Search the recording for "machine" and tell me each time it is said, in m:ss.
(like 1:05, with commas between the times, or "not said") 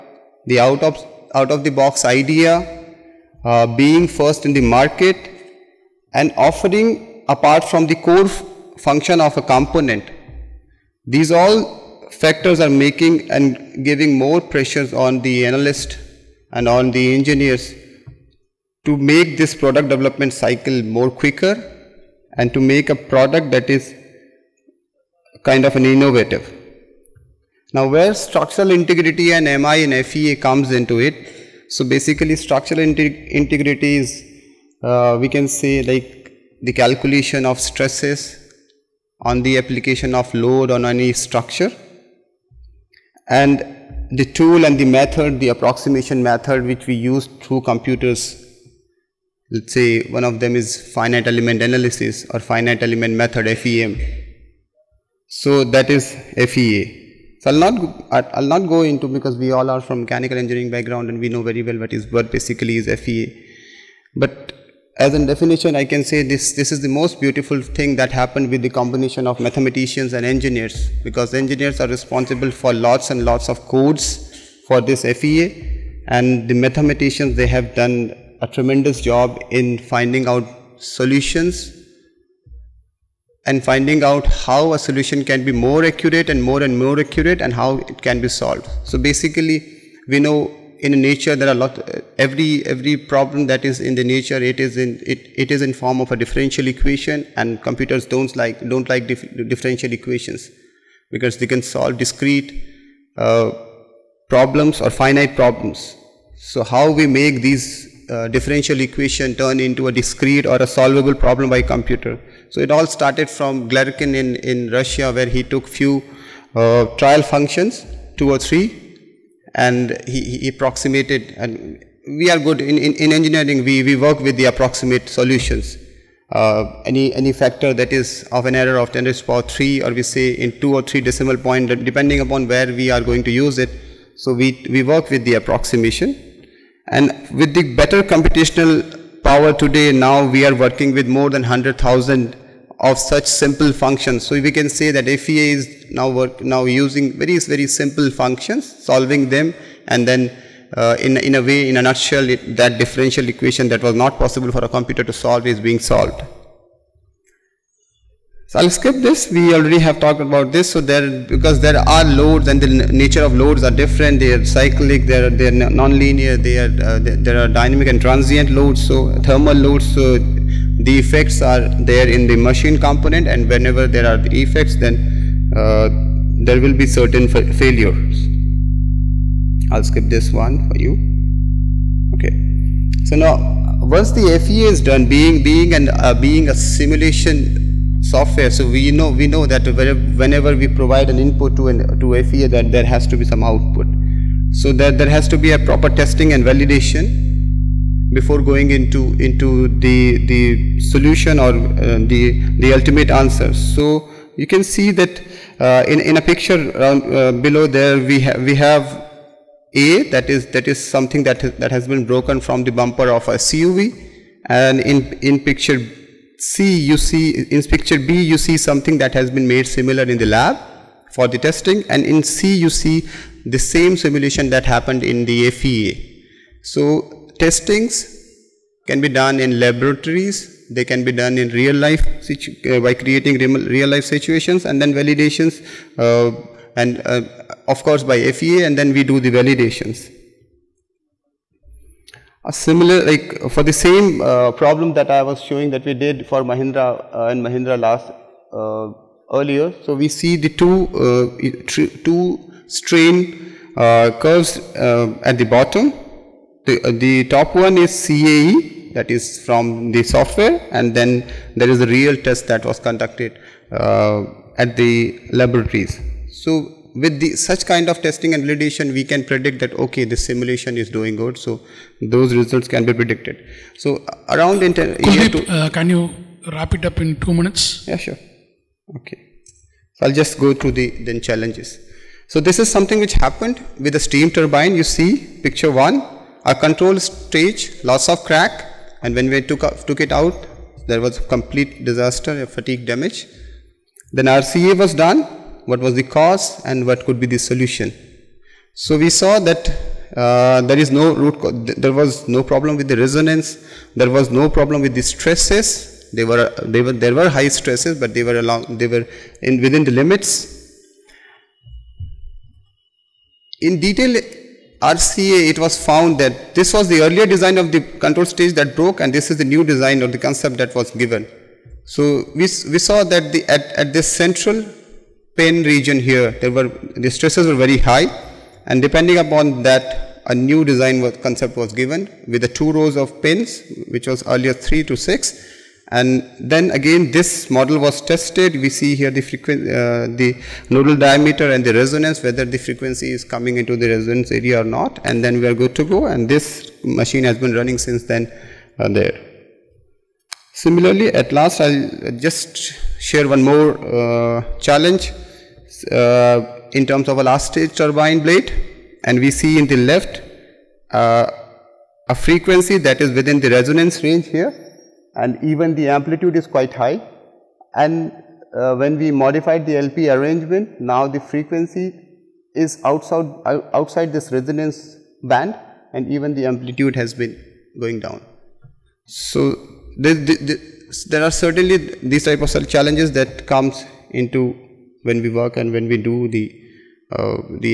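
2:52, 5:46.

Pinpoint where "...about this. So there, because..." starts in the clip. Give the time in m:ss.
2:40.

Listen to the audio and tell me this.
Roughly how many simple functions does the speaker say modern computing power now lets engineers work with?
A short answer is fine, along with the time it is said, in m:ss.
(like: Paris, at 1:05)
100,000, at 2:21.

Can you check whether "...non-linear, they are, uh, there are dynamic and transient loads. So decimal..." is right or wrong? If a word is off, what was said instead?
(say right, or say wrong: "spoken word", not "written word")
wrong: "thermal", not "decimal".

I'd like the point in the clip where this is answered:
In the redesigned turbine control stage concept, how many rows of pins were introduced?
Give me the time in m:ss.
5:32.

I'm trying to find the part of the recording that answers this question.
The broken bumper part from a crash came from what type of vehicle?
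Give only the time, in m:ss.
3:33.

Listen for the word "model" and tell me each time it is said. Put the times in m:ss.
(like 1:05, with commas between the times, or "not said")
5:37.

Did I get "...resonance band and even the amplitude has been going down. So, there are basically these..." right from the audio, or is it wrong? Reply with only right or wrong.
wrong.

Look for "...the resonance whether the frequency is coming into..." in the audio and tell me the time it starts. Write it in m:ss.
5:41.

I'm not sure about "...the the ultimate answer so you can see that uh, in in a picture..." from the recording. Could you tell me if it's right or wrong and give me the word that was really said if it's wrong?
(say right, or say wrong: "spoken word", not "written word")
right.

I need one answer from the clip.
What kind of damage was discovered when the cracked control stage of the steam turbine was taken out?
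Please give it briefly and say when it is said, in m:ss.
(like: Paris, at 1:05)
fatigue damage, at 4:52.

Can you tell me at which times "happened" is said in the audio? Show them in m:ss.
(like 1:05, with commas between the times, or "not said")
1:08, 3:44, 4:43.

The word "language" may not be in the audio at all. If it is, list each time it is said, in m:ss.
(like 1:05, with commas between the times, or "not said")
not said.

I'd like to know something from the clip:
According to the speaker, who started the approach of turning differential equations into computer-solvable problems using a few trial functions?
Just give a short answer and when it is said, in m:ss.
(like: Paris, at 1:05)
Galerkin, at 1:53.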